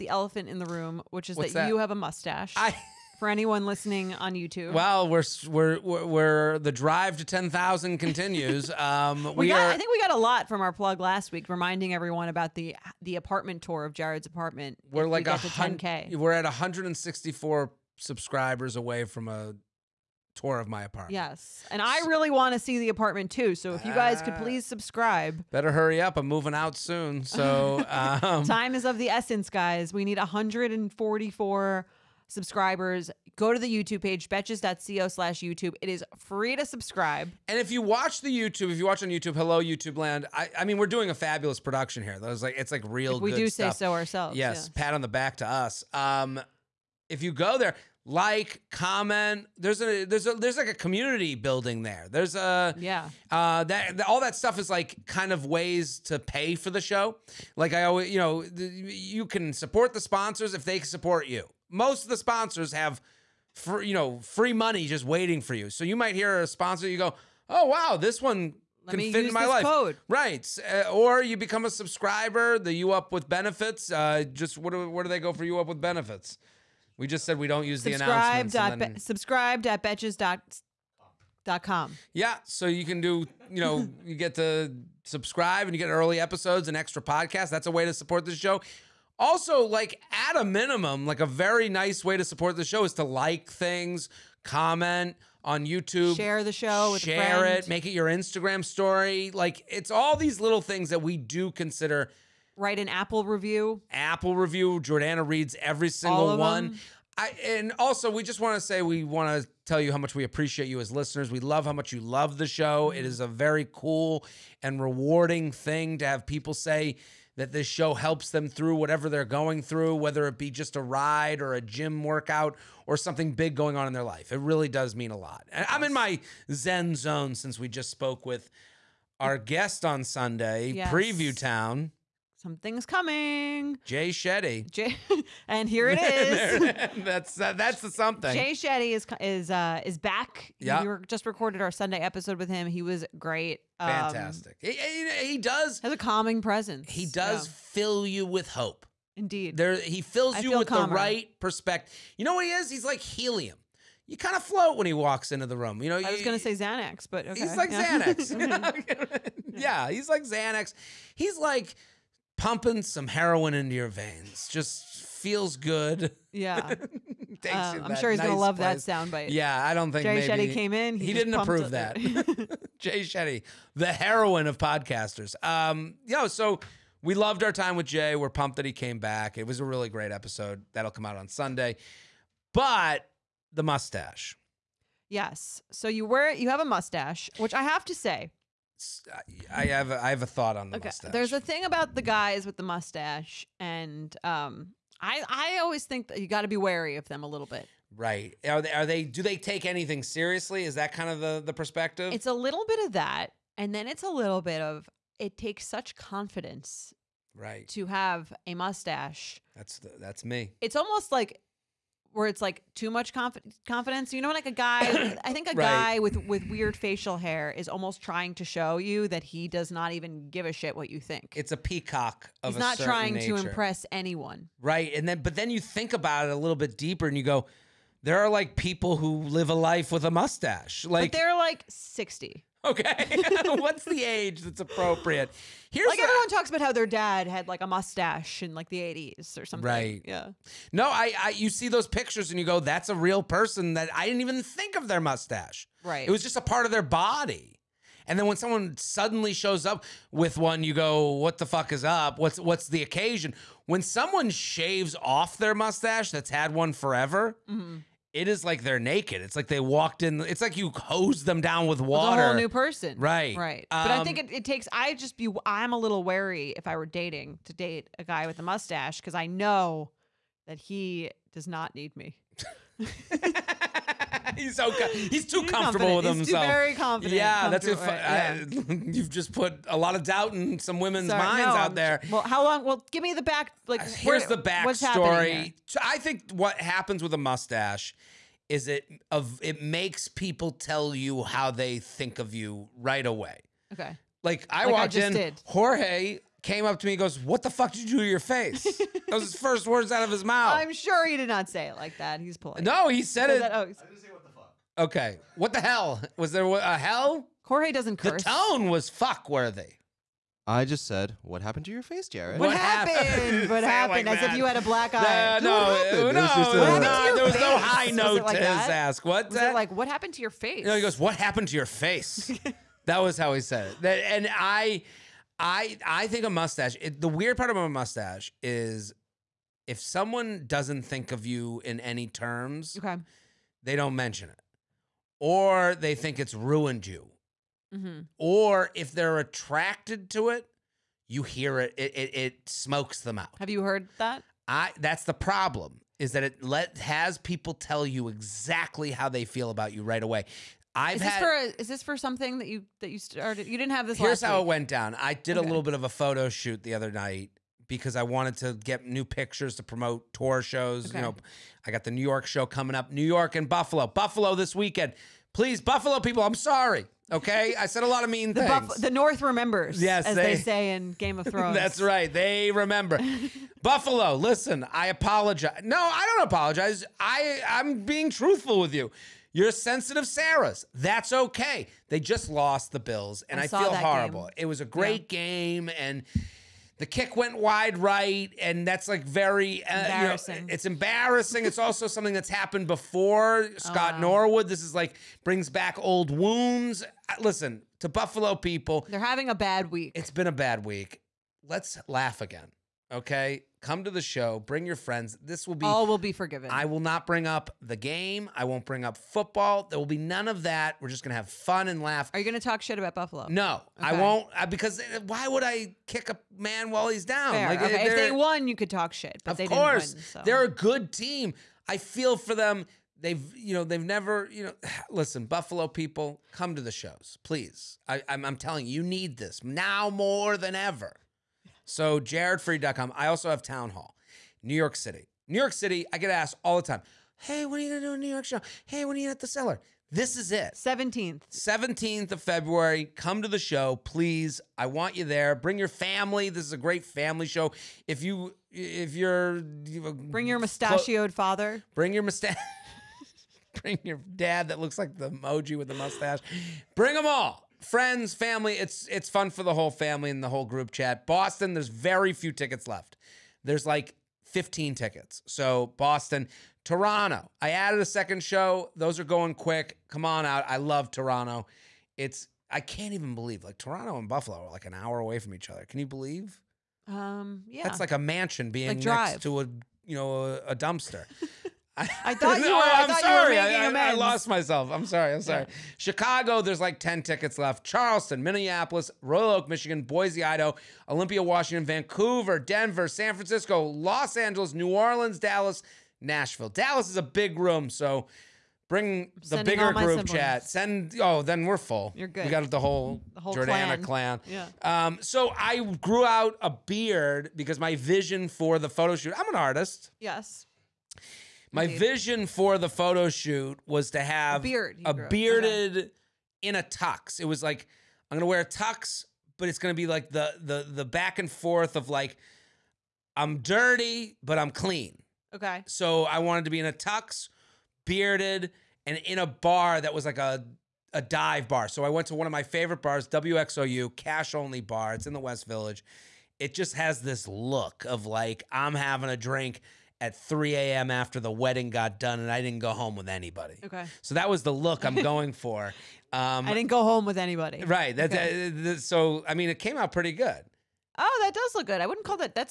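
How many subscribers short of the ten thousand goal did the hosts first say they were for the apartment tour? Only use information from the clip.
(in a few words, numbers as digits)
164.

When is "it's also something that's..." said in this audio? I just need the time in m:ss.
6:31.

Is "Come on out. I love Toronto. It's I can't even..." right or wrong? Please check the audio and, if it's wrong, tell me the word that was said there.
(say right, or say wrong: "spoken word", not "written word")
right.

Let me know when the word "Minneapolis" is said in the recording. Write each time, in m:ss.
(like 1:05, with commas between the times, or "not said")
8:08.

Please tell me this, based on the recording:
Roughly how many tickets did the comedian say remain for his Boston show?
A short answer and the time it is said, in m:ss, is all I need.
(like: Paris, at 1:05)
15, at 7:44.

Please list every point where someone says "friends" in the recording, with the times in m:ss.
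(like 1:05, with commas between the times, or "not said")
6:44, 7:37.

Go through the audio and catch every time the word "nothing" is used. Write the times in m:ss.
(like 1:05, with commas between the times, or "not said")
not said.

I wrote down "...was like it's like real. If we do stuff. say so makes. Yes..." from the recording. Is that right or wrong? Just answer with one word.
wrong.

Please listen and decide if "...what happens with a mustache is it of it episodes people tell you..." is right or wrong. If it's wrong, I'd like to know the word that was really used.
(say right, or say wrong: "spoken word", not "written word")
wrong: "makes", not "episodes".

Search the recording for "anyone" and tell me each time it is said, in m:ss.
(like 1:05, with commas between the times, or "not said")
0:03, 3:43.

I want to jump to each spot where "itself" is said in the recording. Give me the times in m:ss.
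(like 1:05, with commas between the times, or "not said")
not said.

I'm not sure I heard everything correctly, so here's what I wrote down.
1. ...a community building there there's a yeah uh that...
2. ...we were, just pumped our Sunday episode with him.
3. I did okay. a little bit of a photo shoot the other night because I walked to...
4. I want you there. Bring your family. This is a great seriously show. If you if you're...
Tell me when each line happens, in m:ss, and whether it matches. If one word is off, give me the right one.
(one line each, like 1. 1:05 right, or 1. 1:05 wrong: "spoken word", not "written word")
1. 0:50 right
2. 2:20 wrong: "recorded", not "pumped"
3. 5:54 wrong: "wanted", not "walked"
4. 7:24 wrong: "family", not "seriously".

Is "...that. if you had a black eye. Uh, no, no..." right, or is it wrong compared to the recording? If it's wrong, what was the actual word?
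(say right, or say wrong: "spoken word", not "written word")
right.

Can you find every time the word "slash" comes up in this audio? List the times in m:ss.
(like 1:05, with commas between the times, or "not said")
0:35.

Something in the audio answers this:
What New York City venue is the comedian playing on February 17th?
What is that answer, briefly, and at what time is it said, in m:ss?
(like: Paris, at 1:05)
Town Hall, at 7:13.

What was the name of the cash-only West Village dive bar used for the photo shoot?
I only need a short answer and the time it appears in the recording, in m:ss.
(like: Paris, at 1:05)
WXOU, at 8:53.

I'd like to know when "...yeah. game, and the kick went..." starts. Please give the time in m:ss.
6:25.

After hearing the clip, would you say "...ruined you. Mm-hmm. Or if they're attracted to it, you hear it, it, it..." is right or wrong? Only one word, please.
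right.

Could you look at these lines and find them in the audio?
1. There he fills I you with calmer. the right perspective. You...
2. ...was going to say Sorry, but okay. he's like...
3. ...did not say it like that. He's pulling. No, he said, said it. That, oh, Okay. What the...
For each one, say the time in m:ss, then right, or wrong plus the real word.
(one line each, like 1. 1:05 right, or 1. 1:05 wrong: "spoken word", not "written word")
1. 2:29 right
2. 2:36 wrong: "Xanax", not "Sorry"
3. 5:01 right.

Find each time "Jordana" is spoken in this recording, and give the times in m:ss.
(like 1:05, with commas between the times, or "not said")
1:44, 8:23.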